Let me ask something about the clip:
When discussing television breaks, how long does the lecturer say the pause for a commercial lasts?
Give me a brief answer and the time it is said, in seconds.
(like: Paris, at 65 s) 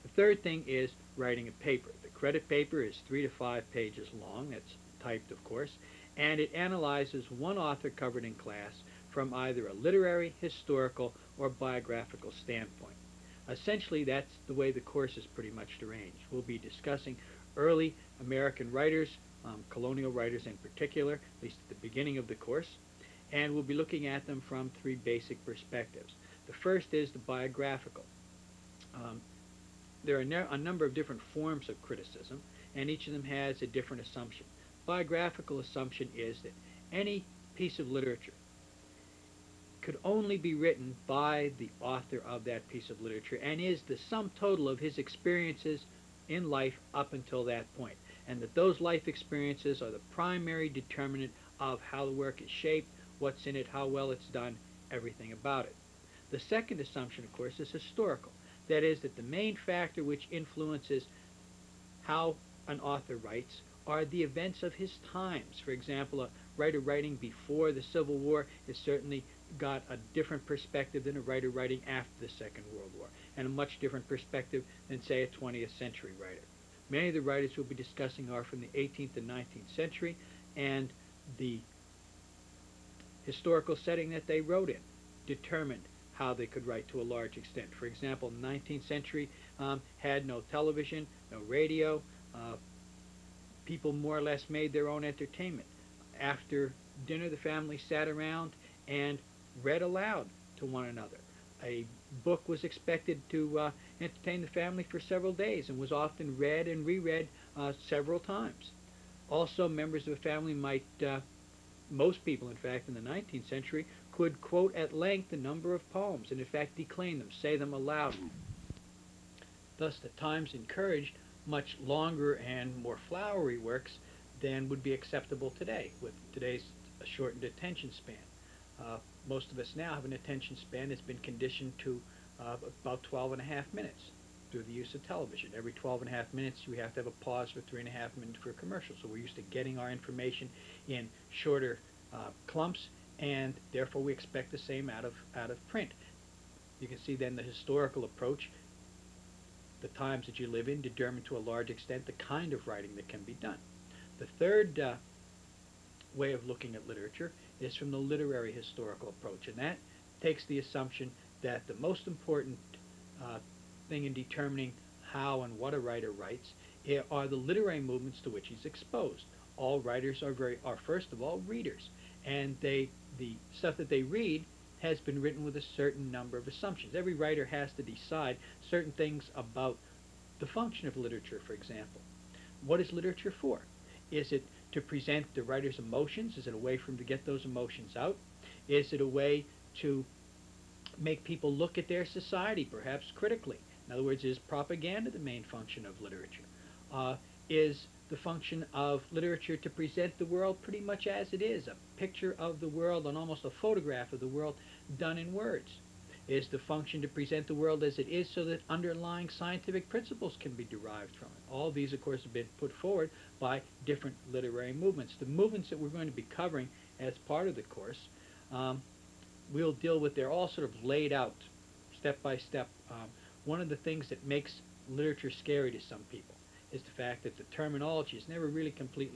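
3 and a half minutes, at 137 s.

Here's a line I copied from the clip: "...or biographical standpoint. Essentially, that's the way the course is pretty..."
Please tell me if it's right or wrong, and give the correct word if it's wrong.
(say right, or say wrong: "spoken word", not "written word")
right.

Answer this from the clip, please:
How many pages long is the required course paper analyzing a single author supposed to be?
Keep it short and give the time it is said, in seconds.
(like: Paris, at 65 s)
3 to 5, at 3 s.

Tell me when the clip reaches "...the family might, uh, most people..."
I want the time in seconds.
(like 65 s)
110 s.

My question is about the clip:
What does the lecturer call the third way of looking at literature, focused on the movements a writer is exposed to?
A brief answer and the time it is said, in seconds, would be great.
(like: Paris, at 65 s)
literary historical approach, at 157 s.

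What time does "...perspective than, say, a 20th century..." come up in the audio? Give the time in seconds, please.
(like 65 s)
74 s.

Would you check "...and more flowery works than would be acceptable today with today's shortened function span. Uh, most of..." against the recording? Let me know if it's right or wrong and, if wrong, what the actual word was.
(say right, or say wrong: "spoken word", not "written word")
wrong: "attention", not "function".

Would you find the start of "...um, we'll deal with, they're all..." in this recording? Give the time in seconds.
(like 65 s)
218 s.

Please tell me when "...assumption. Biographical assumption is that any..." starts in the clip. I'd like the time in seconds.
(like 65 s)
34 s.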